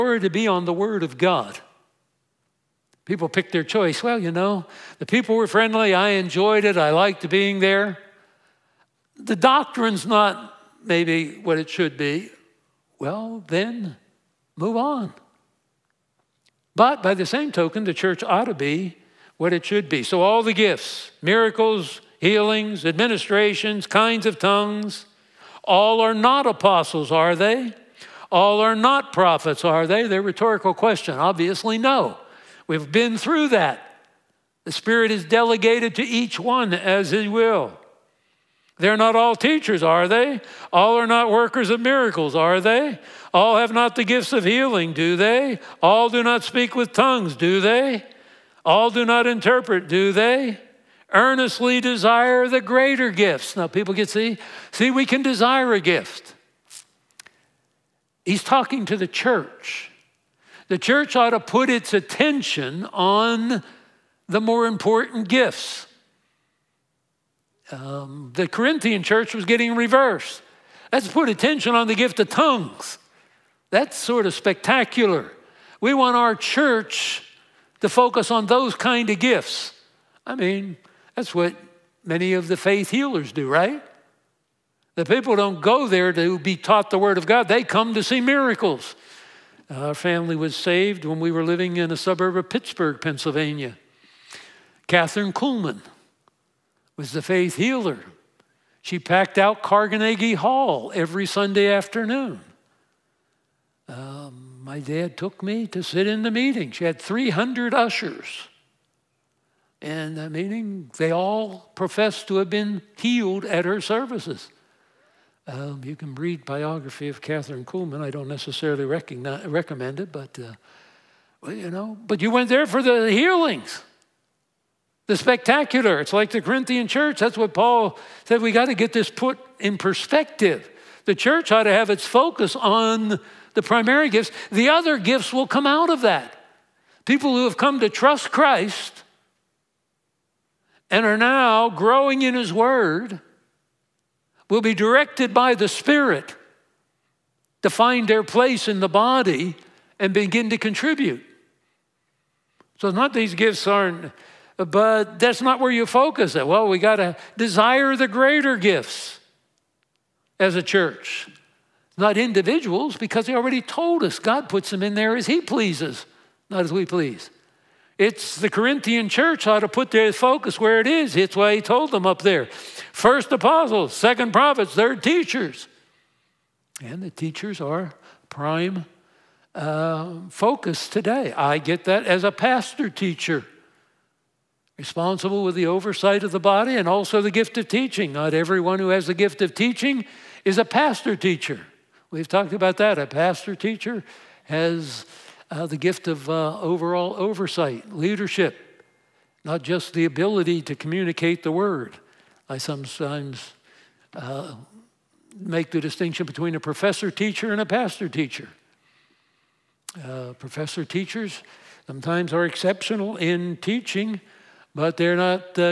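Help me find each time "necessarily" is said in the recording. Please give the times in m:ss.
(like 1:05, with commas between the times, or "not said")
1:58.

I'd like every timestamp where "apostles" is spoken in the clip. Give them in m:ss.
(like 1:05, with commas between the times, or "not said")
0:26, 2:53.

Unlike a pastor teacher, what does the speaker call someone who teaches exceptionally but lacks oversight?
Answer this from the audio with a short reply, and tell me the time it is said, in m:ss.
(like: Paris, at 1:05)
professor teacher, at 3:26.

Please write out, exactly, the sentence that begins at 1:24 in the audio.
The people don't go there to be taught the Word of God, they come to see miracles.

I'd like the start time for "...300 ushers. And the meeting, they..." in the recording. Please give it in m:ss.
1:47.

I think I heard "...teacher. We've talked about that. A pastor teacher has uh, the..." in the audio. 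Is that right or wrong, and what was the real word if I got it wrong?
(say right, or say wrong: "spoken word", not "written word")
right.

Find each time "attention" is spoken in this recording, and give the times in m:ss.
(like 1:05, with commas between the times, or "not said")
1:01, 1:11.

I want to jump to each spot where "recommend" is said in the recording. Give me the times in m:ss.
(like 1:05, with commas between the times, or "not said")
1:58.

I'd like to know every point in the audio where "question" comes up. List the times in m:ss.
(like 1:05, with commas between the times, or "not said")
0:30.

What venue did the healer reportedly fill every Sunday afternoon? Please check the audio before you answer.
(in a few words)
Carnegie Hall.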